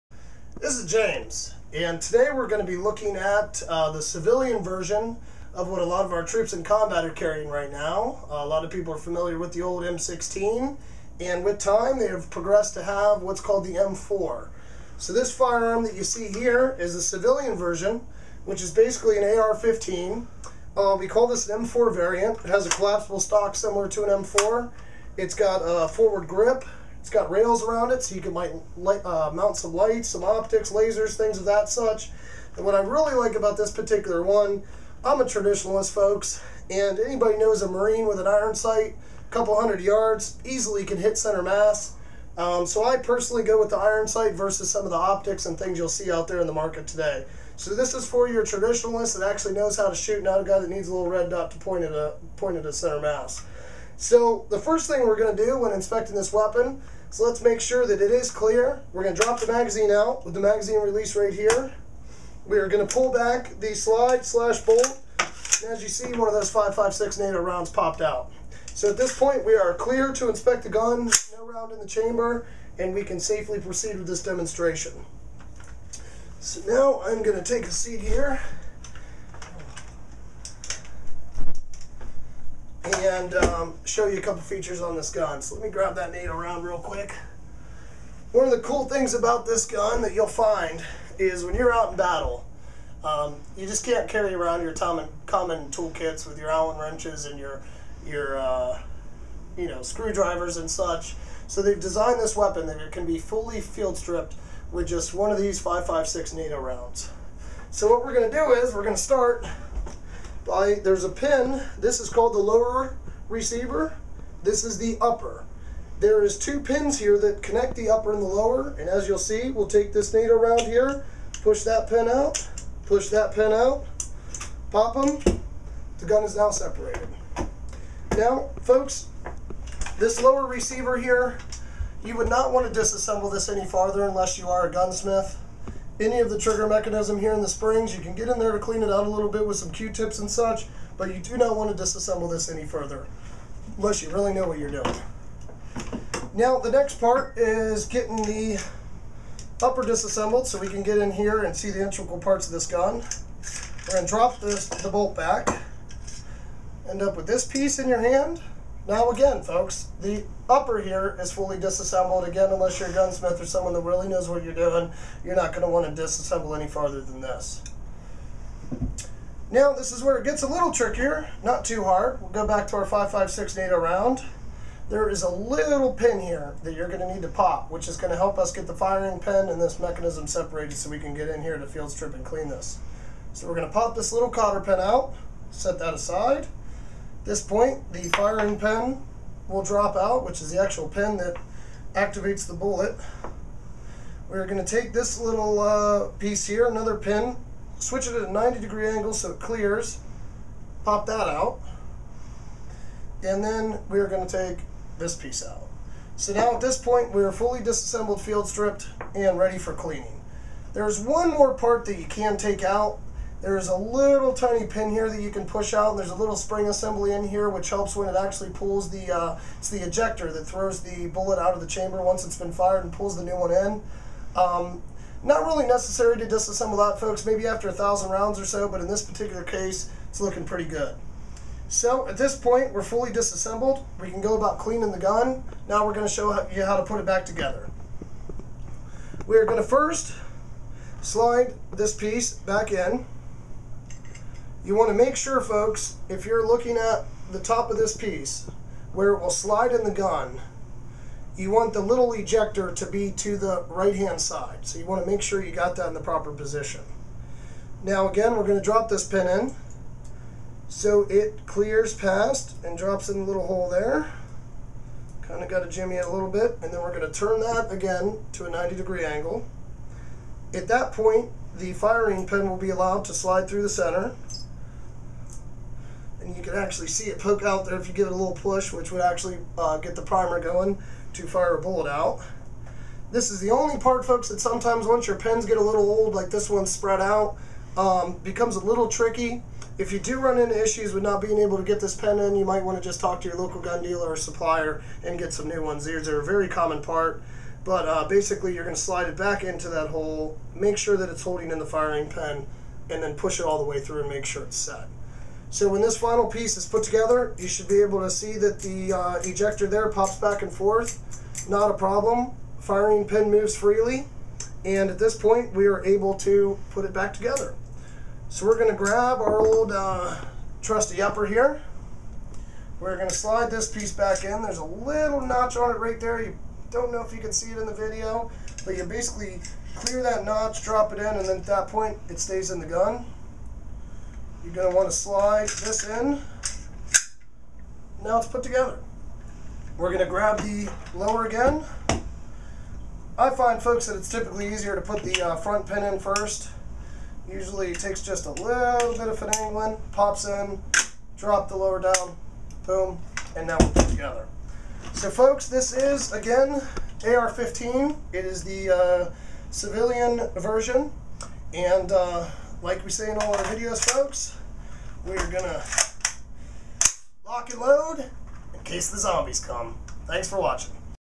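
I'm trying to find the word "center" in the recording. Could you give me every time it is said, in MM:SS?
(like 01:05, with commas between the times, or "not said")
00:41, 00:52, 04:33.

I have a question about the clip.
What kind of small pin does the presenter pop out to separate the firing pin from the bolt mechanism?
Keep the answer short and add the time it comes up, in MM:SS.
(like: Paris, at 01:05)
cotter pin, at 03:04.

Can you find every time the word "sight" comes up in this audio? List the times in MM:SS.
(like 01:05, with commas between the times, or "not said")
00:38, 00:44.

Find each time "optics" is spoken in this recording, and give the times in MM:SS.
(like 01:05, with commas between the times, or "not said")
00:30, 00:44.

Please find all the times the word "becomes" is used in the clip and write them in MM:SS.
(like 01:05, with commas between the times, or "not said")
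04:48.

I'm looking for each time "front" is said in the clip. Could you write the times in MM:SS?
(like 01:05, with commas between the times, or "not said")
05:45.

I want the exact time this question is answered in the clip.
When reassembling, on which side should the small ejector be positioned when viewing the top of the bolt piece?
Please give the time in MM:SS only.
04:13.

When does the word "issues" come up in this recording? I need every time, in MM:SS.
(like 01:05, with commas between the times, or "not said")
04:50.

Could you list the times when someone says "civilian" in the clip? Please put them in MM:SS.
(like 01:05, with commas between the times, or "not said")
00:04, 00:17, 05:59.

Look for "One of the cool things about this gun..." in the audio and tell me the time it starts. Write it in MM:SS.
01:28.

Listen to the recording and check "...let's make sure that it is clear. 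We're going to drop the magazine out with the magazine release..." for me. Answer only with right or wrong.
right.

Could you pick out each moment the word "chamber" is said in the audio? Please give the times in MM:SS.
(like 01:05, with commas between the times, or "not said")
01:11, 03:41.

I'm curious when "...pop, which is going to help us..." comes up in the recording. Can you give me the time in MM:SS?
02:57.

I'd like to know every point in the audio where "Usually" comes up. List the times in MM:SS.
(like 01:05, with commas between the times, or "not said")
05:47.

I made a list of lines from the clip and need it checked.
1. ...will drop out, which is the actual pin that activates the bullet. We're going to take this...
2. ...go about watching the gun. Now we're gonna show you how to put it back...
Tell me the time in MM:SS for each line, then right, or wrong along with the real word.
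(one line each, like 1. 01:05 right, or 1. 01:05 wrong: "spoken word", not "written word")
1. 03:09 right
2. 03:54 wrong: "cleaning", not "watching".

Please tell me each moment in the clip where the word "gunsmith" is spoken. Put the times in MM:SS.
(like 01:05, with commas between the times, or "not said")
02:14, 02:42.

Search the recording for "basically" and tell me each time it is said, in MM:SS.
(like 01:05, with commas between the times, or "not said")
00:18, 04:58, 05:28.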